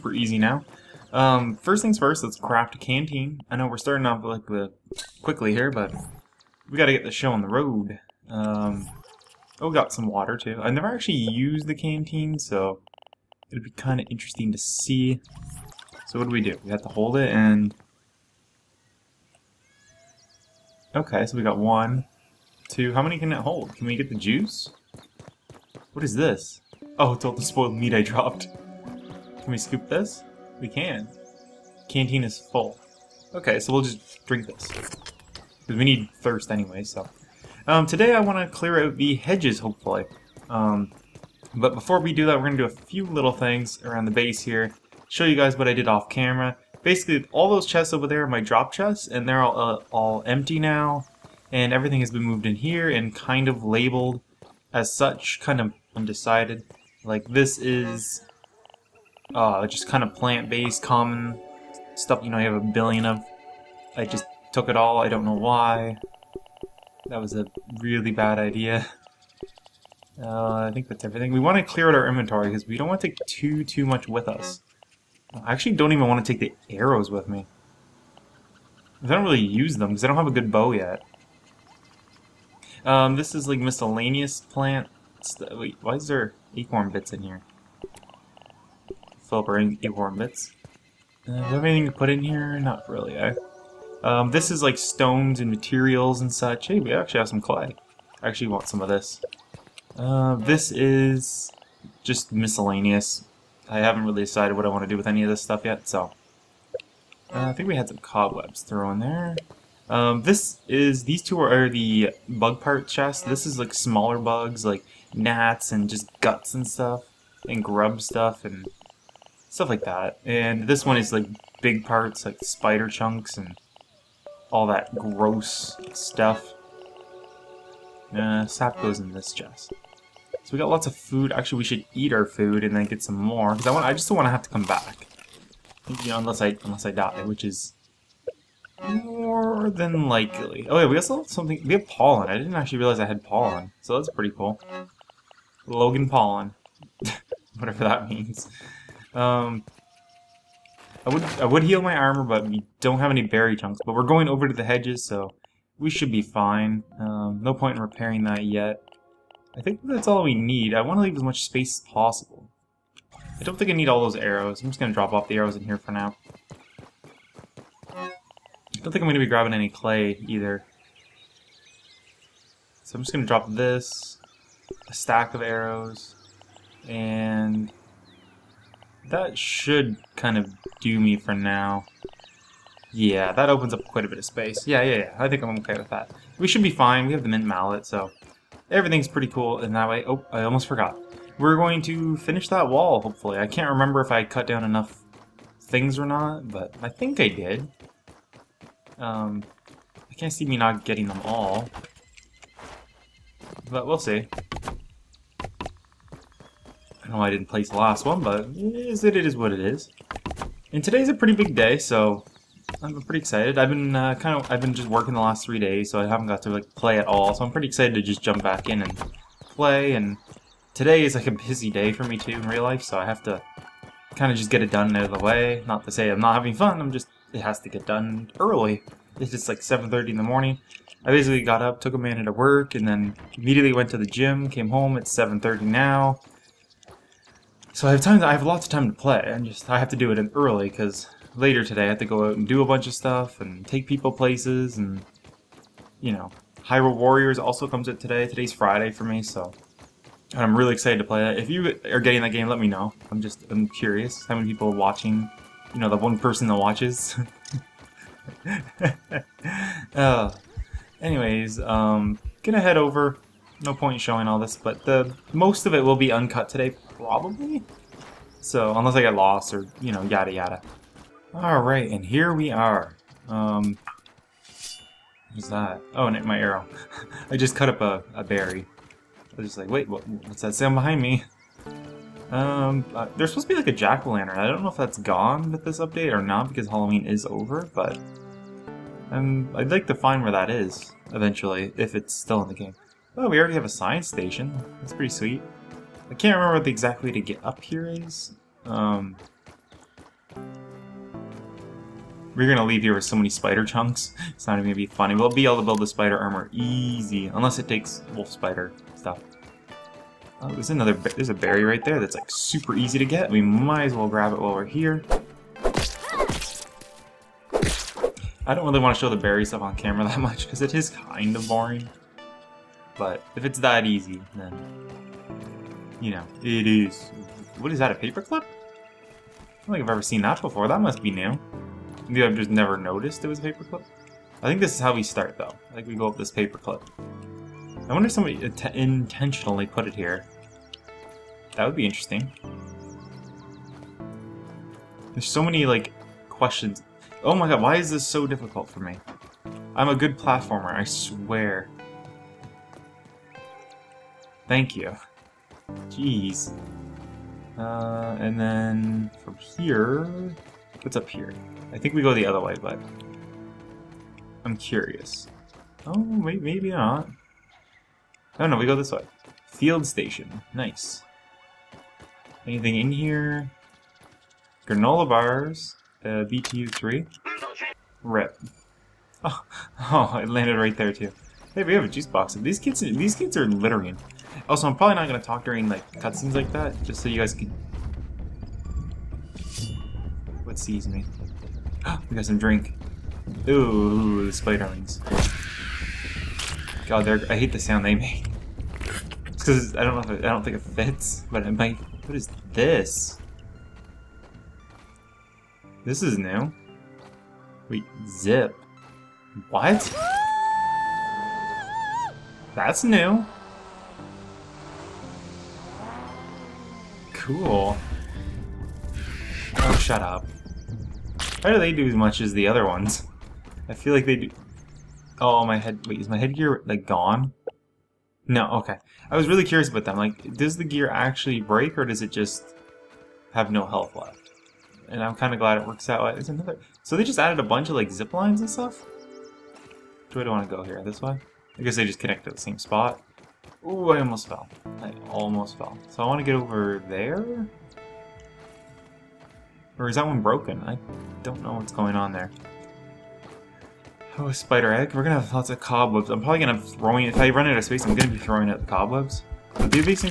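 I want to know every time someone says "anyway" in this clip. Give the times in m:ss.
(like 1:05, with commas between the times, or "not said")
0:36, 4:20.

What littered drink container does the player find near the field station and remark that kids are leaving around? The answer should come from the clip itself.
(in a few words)
Juice box.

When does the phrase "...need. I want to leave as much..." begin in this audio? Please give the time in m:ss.
2:40.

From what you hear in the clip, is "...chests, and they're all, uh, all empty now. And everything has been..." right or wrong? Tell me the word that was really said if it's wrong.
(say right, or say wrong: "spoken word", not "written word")
right.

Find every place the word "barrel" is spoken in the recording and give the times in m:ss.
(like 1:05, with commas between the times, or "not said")
not said.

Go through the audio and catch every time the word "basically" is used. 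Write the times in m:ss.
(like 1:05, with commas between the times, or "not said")
0:46, 3:51.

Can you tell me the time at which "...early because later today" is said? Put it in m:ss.
4:00.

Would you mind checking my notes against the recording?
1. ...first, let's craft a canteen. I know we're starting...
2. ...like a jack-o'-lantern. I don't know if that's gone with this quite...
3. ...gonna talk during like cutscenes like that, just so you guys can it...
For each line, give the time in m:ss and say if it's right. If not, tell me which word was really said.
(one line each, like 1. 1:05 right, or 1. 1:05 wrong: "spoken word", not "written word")
1. 0:01 right
2. 4:43 wrong: "update", not "quite"
3. 6:25 right.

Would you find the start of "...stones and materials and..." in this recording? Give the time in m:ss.
1:34.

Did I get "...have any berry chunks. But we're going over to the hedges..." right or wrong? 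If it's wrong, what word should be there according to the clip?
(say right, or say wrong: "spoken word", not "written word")
right.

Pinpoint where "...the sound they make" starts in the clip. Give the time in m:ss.
6:37.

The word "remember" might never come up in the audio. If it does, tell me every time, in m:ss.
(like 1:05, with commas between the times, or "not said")
3:13, 4:56.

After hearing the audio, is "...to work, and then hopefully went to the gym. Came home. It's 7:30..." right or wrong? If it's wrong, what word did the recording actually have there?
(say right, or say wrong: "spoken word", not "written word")
wrong: "immediately", not "hopefully".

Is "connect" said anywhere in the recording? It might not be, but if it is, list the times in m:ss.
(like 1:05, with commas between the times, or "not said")
7:21.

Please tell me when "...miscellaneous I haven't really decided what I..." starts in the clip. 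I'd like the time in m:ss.
1:42.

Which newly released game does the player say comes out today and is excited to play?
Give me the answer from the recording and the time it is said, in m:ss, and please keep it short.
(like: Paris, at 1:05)
Hyrule Warriors, at 4:06.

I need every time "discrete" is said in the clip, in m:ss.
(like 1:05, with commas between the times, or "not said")
not said.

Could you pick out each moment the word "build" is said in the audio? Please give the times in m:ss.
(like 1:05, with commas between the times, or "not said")
5:05.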